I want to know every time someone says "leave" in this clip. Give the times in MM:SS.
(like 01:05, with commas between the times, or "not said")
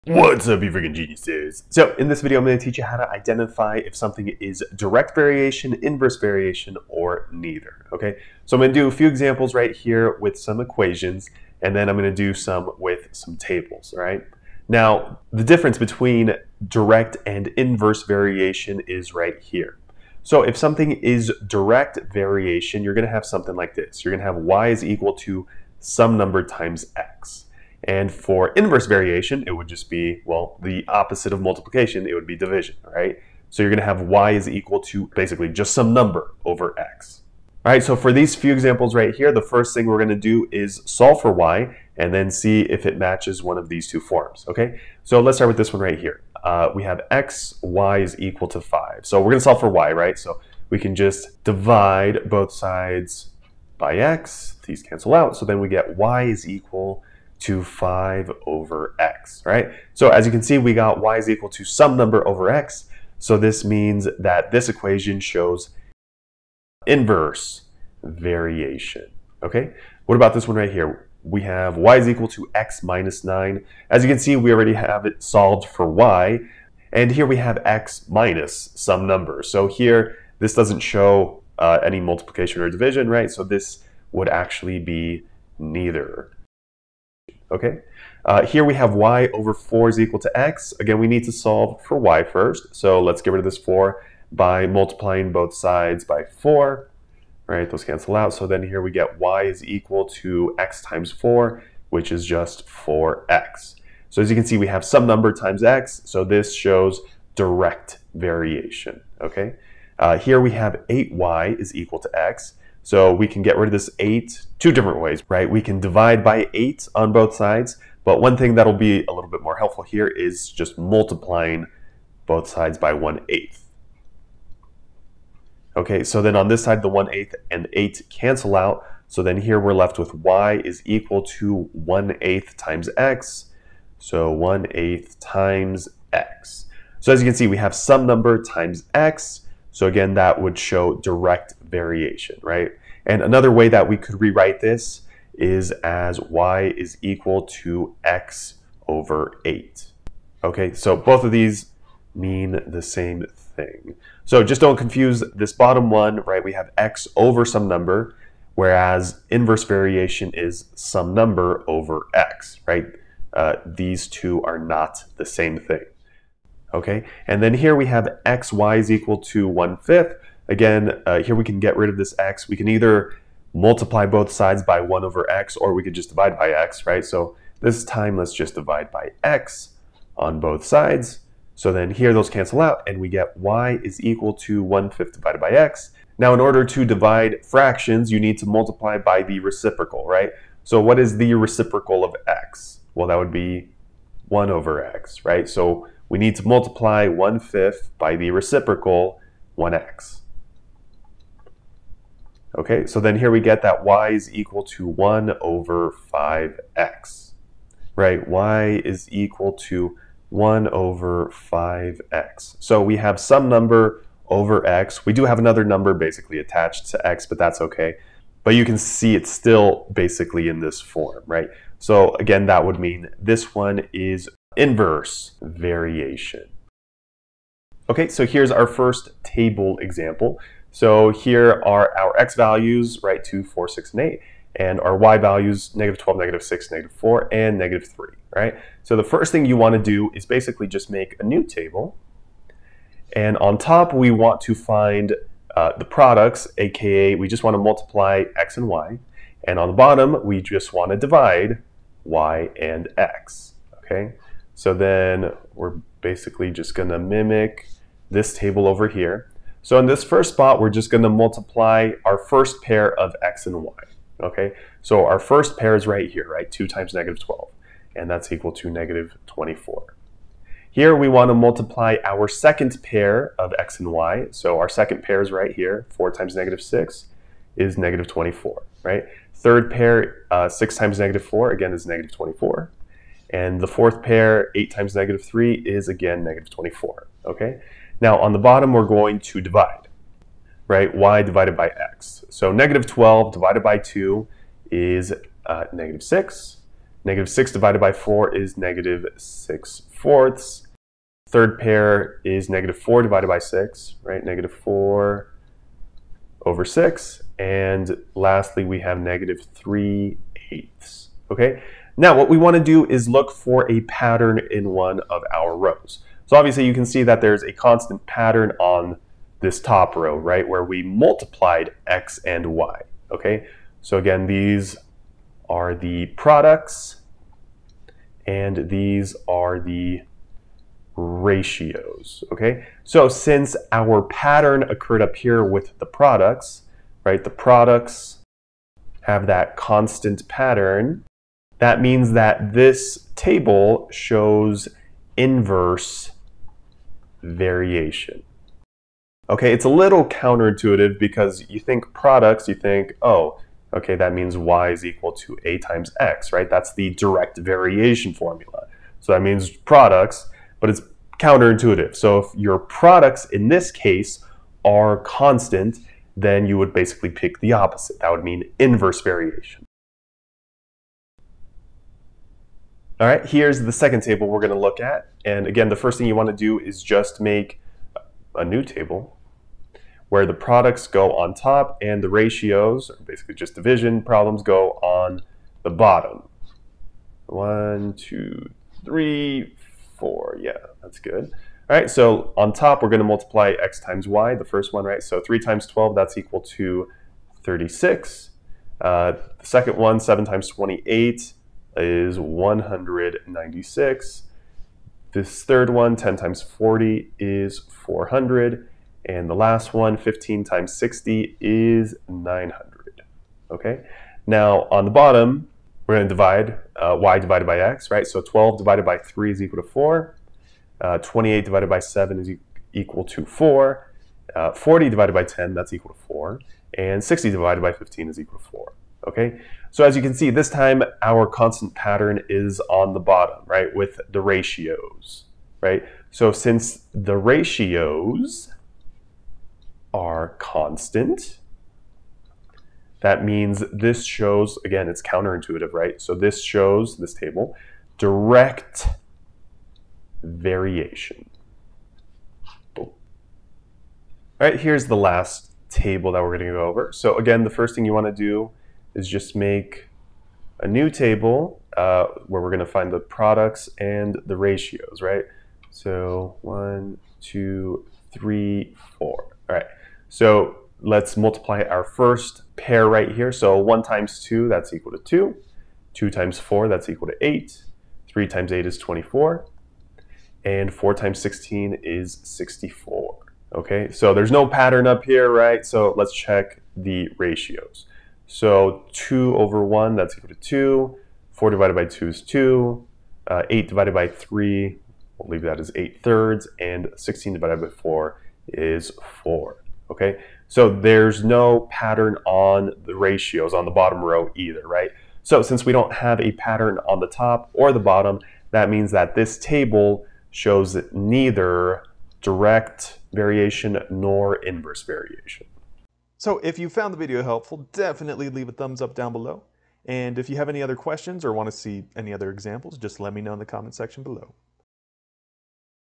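08:15, 08:38.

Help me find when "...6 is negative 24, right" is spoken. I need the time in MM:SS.
04:36.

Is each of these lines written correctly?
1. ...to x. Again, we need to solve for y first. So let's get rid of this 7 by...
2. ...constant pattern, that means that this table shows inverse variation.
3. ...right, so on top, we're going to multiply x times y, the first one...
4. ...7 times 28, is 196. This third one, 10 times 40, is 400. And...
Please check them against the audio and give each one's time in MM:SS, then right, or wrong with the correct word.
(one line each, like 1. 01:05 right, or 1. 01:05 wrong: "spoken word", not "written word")
1. 01:30 wrong: "4", not "7"
2. 05:39 right
3. 06:31 right
4. 06:39 right.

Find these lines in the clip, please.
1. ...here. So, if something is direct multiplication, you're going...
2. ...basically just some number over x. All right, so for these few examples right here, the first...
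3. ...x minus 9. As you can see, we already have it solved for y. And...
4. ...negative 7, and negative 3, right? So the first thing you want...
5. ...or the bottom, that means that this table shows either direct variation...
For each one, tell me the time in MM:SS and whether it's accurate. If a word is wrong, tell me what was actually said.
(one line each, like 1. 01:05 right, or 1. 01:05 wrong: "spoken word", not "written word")
1. 00:19 wrong: "variation", not "multiplication"
2. 00:35 right
3. 01:12 right
4. 03:56 wrong: "4", not "7"
5. 08:27 wrong: "neither", not "either".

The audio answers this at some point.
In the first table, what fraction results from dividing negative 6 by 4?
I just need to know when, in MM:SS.
04:58.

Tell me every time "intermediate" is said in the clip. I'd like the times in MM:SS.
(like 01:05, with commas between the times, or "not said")
not said.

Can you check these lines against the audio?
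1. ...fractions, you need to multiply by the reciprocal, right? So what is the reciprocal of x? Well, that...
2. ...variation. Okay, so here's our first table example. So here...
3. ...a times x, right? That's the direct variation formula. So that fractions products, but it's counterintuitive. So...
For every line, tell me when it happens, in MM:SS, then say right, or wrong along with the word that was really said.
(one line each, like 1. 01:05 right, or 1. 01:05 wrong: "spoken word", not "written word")
1. 03:07 right
2. 03:45 right
3. 05:55 wrong: "means", not "fractions".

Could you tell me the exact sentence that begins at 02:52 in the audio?
We can either multiply both sides by 1 over x, or we could just divide by x, right?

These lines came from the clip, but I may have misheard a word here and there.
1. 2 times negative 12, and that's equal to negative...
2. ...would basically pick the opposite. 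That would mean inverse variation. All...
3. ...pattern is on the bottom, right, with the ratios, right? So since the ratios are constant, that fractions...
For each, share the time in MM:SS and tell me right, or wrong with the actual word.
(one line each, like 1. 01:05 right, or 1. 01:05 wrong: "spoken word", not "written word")
1. 04:26 right
2. 06:06 right
3. 07:11 wrong: "means", not "fractions".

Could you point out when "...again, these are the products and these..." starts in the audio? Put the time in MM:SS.
05:23.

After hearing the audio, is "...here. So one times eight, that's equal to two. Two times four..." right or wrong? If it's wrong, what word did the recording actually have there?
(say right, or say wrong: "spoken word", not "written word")
wrong: "two", not "eight".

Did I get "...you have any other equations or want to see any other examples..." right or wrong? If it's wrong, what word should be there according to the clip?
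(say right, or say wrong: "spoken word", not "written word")
wrong: "questions", not "equations".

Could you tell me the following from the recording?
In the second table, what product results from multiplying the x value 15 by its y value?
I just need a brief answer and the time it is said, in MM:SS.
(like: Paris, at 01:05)
900, at 06:52.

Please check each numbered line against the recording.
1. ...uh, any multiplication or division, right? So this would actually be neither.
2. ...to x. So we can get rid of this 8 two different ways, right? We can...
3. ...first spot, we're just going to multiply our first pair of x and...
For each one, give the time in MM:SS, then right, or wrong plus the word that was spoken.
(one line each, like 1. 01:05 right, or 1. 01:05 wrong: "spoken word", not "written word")
1. 01:21 right
2. 01:51 right
3. 04:20 right.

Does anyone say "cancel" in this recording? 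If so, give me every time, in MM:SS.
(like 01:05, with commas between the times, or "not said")
00:54, 01:37, 02:08, 03:02.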